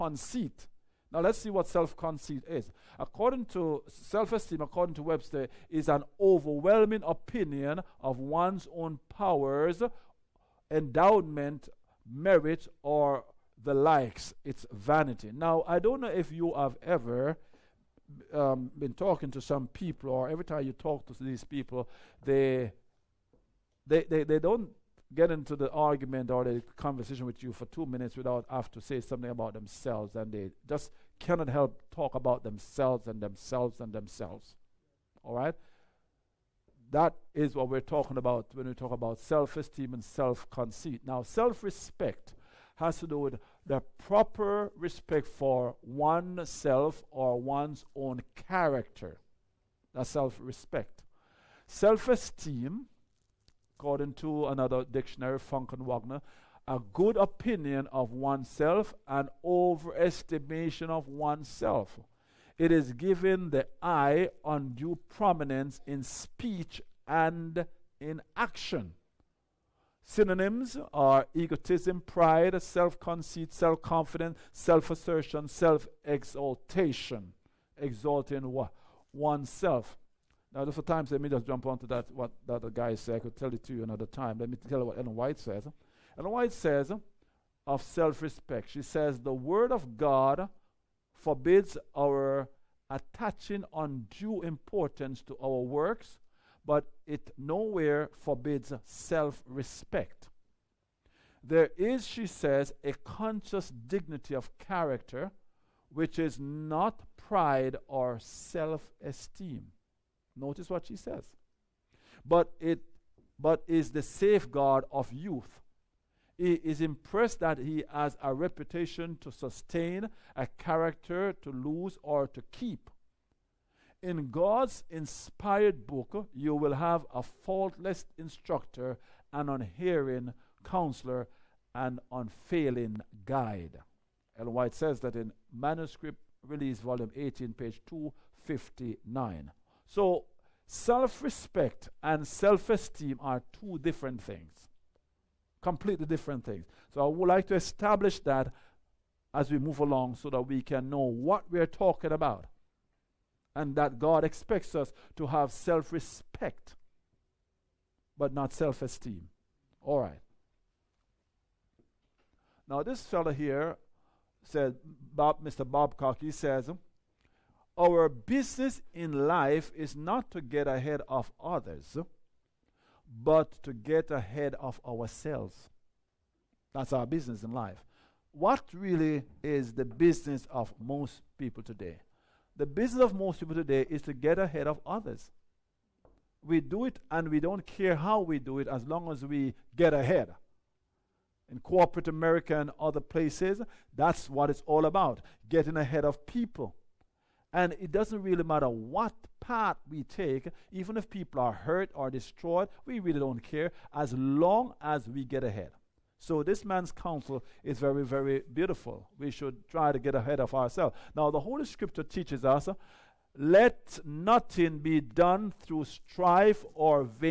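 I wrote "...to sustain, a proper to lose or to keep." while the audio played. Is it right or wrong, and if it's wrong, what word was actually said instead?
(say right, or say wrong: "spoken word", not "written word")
wrong: "character", not "proper".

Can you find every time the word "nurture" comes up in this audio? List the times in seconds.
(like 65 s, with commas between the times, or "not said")
not said.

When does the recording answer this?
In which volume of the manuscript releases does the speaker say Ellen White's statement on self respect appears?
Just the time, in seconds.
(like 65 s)
136 s.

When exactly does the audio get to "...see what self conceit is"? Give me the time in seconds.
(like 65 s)
1 s.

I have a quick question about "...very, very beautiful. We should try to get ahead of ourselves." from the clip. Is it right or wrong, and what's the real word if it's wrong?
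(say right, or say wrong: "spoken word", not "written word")
right.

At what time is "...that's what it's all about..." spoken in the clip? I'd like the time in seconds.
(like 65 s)
193 s.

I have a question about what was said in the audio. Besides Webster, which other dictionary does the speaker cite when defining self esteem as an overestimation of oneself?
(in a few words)
Funk and Wagnalls.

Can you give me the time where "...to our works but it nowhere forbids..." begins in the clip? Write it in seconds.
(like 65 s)
95 s.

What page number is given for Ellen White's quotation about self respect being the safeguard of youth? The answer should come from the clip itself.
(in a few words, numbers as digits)
259.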